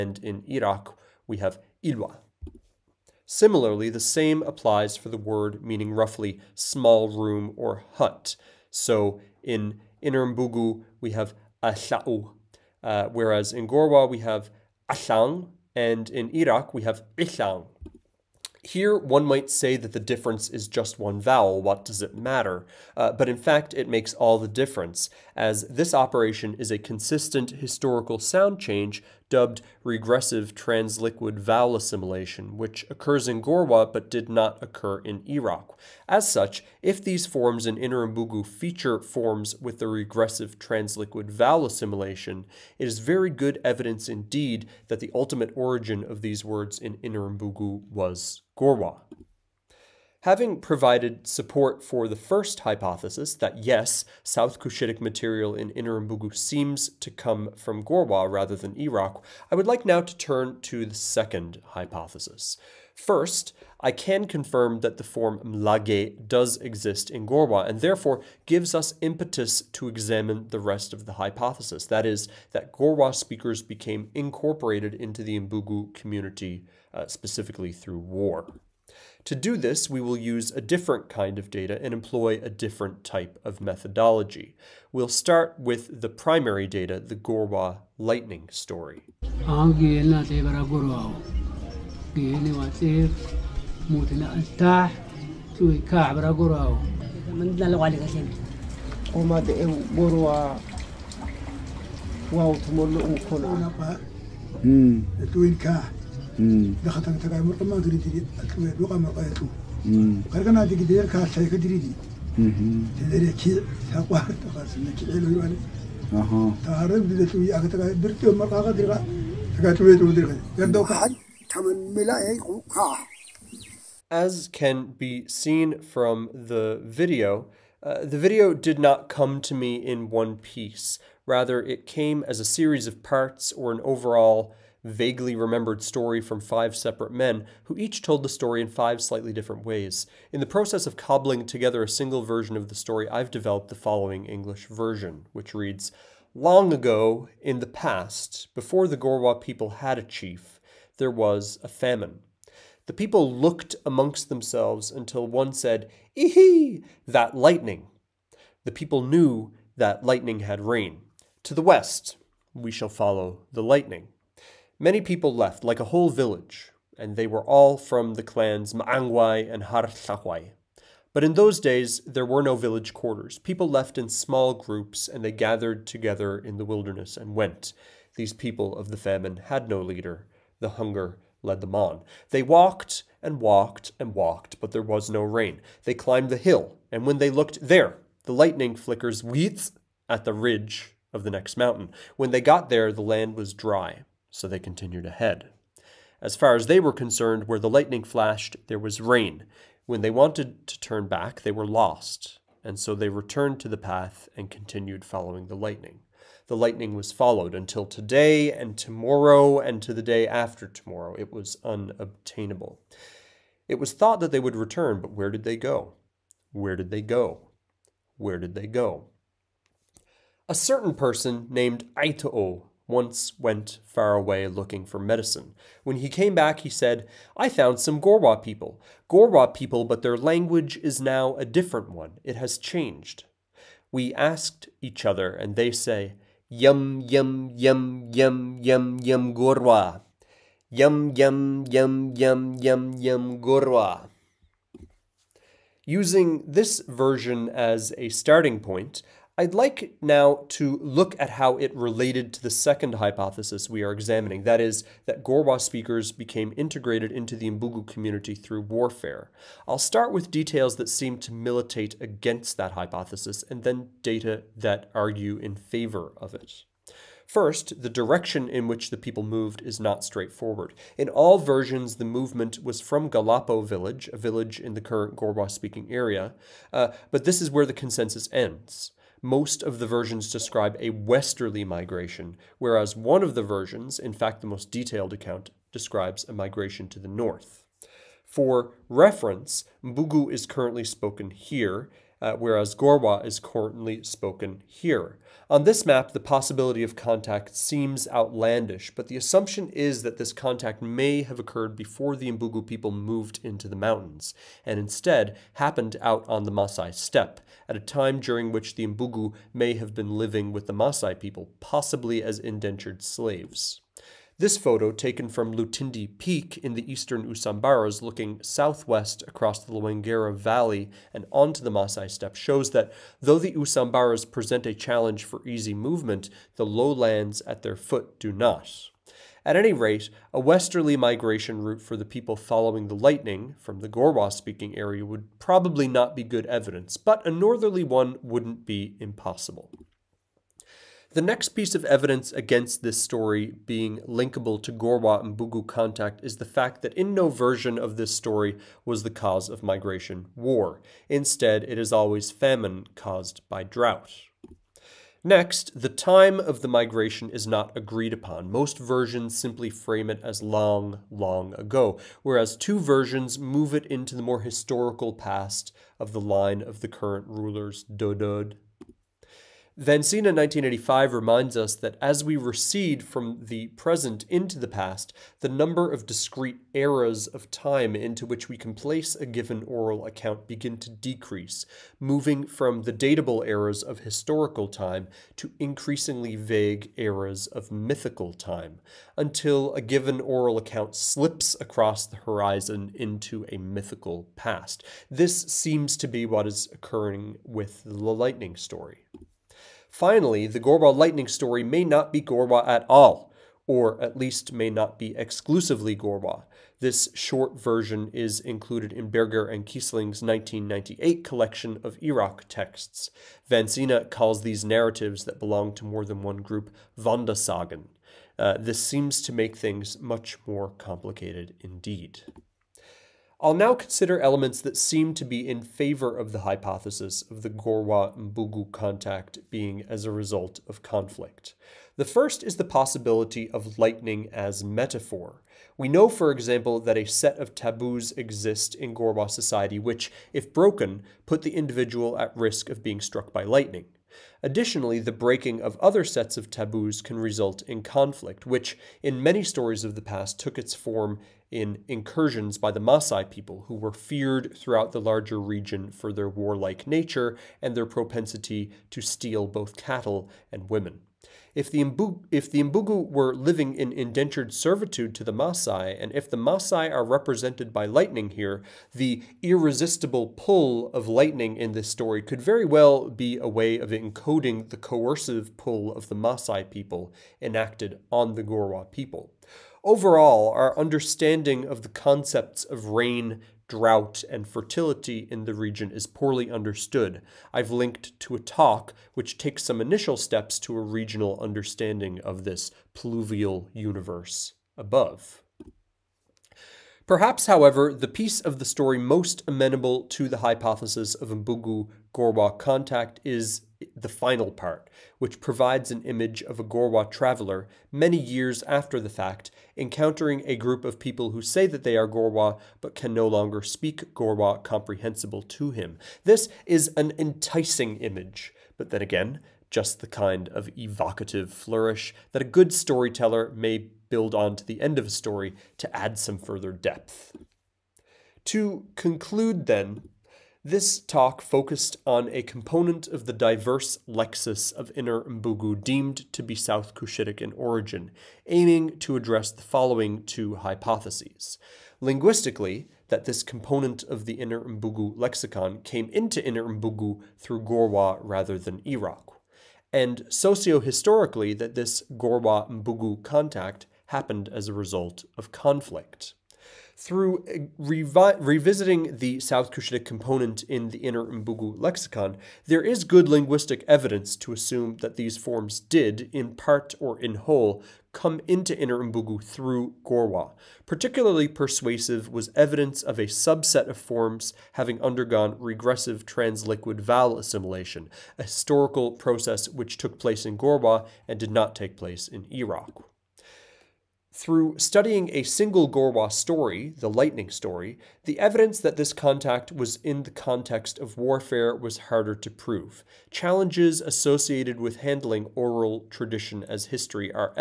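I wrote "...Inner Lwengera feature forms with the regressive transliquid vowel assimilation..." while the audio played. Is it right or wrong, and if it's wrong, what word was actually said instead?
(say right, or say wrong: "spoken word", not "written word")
wrong: "Mbugu", not "Lwengera".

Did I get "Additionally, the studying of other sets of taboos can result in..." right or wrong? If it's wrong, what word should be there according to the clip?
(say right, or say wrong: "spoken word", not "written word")
wrong: "breaking", not "studying".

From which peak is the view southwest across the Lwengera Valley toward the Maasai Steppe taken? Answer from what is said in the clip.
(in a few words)
Lutindi Peak.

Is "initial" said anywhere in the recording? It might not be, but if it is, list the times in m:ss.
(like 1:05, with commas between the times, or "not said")
8:09.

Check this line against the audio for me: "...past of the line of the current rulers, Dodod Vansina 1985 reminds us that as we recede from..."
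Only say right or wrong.
right.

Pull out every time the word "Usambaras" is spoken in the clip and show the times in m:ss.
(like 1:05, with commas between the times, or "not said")
5:17, 5:23.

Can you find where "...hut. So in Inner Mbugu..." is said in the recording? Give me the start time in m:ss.
0:07.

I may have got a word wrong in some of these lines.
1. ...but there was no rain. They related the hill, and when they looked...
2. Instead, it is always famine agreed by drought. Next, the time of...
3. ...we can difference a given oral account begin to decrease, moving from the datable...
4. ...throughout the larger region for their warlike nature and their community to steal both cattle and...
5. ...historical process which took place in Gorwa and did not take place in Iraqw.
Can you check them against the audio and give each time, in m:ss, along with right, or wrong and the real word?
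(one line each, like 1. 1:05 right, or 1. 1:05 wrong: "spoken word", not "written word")
1. 3:04 wrong: "climbed", not "related"
2. 5:51 wrong: "caused", not "agreed"
3. 6:18 wrong: "place", not "difference"
4. 7:34 wrong: "propensity", not "community"
5. 9:38 right.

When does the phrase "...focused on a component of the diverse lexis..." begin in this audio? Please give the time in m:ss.
8:51.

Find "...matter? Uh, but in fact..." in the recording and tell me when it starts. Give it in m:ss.
0:22.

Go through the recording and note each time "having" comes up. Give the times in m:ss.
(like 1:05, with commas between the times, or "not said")
0:50, 9:34.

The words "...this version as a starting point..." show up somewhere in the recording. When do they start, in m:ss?
4:06.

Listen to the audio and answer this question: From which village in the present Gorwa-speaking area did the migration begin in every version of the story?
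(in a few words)
Galapo.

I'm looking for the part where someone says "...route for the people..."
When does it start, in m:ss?
5:31.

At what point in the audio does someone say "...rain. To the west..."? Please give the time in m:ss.
2:40.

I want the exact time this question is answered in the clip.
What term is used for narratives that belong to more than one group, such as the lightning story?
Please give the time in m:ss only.
6:56.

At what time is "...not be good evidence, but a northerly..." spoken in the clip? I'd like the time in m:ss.
5:35.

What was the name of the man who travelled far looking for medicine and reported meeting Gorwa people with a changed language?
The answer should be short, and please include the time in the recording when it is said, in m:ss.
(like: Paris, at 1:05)
Aitoo, at 3:41.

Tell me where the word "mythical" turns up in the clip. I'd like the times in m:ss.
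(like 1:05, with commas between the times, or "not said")
6:27, 6:33.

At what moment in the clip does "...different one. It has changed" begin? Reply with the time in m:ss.
3:51.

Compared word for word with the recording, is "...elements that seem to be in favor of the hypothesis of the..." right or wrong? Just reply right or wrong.
right.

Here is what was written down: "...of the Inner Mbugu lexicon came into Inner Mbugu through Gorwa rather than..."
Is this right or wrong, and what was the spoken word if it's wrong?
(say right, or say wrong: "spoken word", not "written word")
right.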